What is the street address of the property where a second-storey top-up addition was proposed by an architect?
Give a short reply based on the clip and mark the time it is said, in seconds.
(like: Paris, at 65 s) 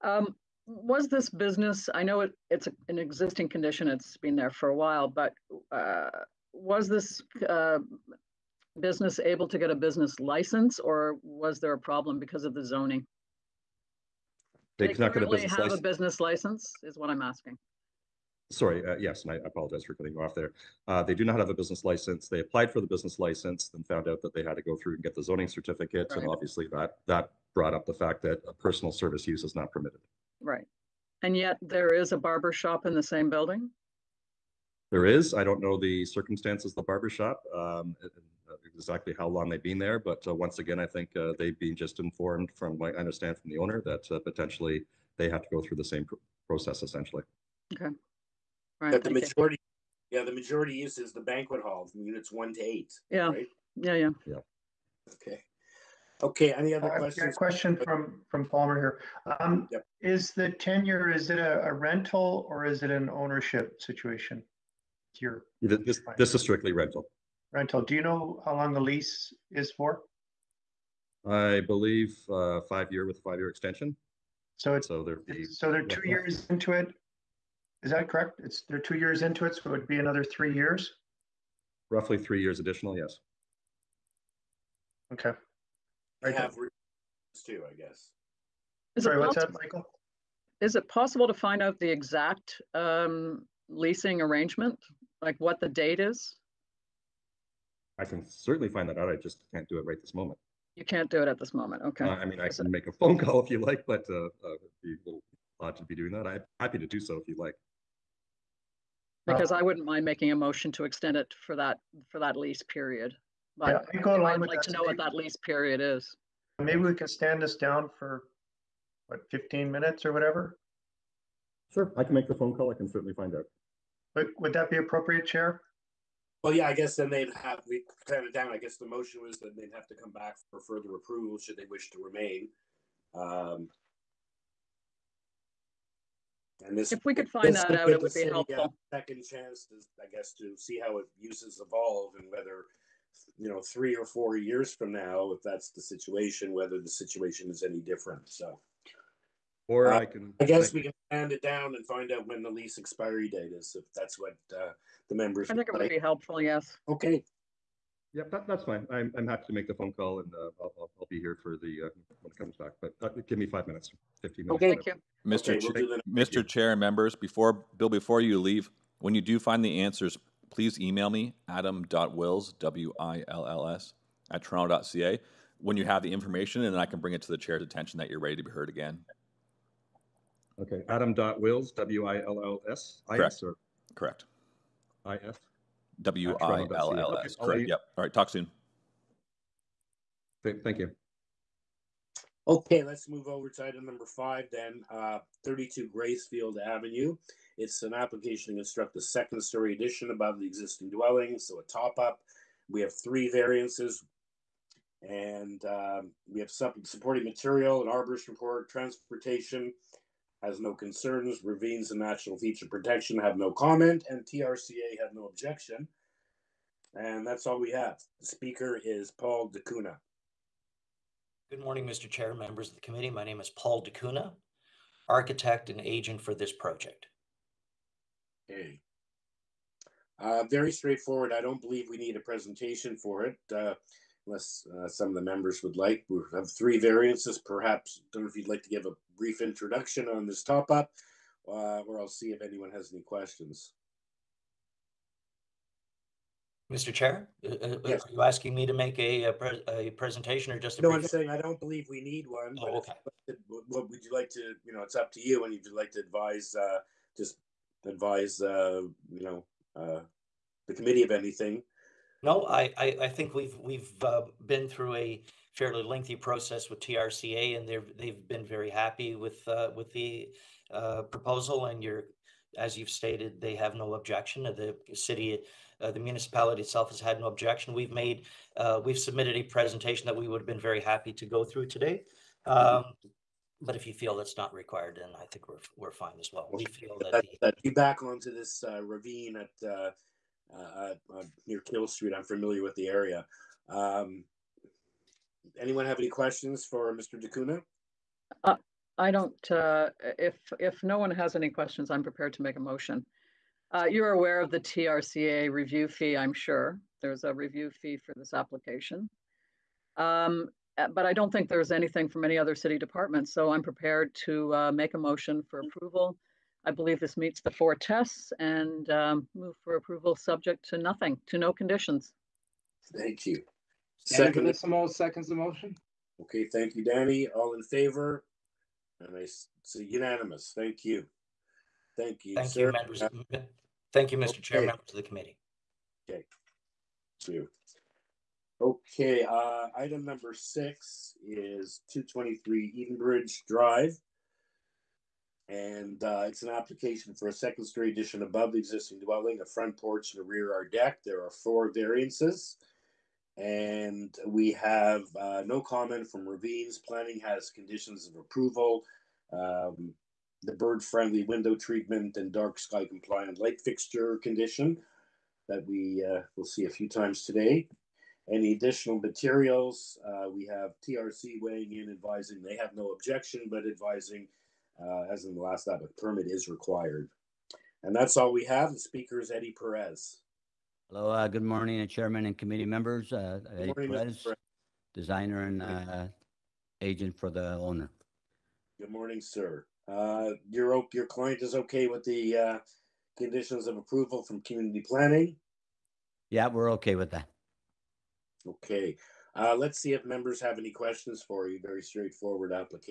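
32 Gracefield Avenue, at 195 s.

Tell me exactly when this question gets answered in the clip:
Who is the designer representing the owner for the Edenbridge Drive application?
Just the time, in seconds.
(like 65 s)
379 s.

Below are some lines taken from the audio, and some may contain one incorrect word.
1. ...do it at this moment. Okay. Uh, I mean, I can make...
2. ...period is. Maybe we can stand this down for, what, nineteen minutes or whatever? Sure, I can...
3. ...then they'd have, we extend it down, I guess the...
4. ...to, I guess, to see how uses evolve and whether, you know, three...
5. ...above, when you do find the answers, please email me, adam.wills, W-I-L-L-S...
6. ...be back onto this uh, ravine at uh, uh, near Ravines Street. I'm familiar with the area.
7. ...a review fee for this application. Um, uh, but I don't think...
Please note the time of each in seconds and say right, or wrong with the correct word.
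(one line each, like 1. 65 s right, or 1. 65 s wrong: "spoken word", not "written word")
1. 101 s right
2. 115 s wrong: "fifteen", not "nineteen"
3. 126 s wrong: "stand", not "extend"
4. 139 s right
5. 168 s wrong: "leave", not "above"
6. 287 s wrong: "Kill", not "Ravines"
7. 307 s right.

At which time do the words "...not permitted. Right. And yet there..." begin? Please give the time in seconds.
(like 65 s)
29 s.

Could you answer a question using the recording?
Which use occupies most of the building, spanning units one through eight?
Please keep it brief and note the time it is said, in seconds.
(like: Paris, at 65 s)
Banquet hall, at 51 s.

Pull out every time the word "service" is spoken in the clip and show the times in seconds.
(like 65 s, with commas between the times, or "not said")
28 s.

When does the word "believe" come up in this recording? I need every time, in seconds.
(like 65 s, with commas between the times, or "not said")
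71 s, 231 s, 251 s, 316 s.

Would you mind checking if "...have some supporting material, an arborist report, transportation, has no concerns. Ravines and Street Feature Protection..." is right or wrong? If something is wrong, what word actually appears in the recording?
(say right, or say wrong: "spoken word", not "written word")
wrong: "Natural", not "Street".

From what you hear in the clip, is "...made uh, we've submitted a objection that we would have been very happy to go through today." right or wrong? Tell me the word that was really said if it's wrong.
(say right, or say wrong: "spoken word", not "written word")
wrong: "presentation", not "objection".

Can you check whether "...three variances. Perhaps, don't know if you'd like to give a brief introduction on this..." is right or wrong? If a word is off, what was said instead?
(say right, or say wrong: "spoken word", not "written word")
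right.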